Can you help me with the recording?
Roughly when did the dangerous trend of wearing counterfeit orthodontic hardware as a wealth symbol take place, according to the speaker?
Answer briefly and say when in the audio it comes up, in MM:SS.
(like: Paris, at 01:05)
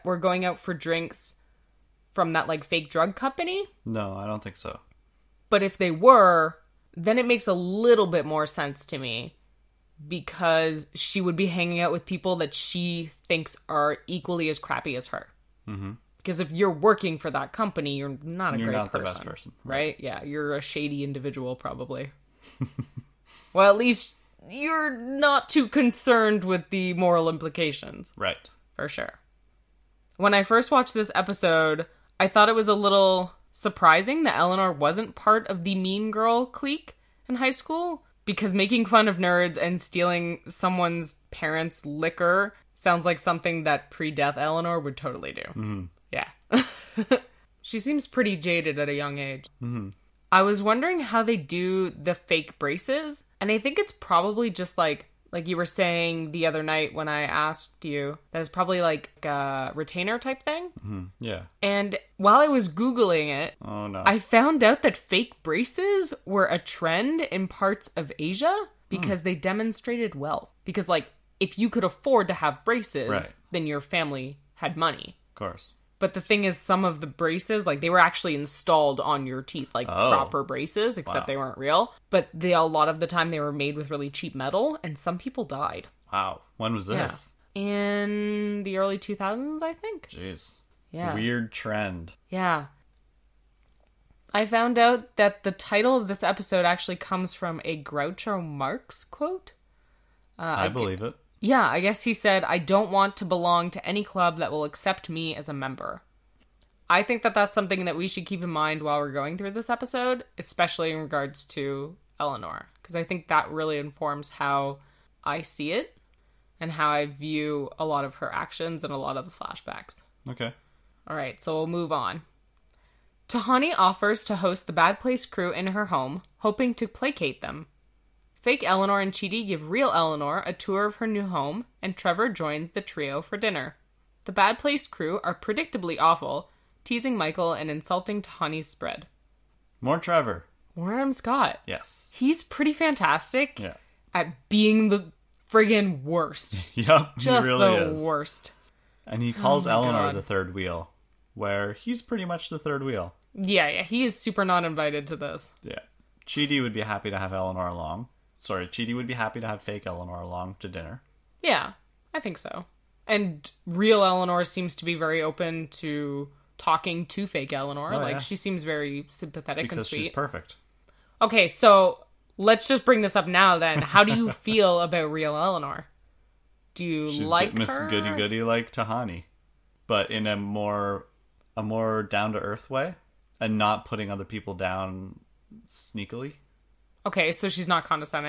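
early 2000s, at 01:28.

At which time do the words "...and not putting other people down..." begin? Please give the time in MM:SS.
03:03.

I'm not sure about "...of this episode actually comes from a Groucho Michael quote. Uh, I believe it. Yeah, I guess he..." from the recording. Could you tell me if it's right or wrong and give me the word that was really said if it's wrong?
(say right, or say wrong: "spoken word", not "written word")
wrong: "Marx", not "Michael".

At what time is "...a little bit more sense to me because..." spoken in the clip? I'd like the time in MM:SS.
00:07.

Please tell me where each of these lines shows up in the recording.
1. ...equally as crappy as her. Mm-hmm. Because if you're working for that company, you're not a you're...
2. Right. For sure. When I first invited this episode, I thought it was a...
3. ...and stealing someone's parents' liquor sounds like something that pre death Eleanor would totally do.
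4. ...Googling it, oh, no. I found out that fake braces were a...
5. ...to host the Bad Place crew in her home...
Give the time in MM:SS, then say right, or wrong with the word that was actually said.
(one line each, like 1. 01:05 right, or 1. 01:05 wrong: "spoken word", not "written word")
1. 00:14 right
2. 00:28 wrong: "watched", not "invited"
3. 00:39 right
4. 01:02 right
5. 02:04 right.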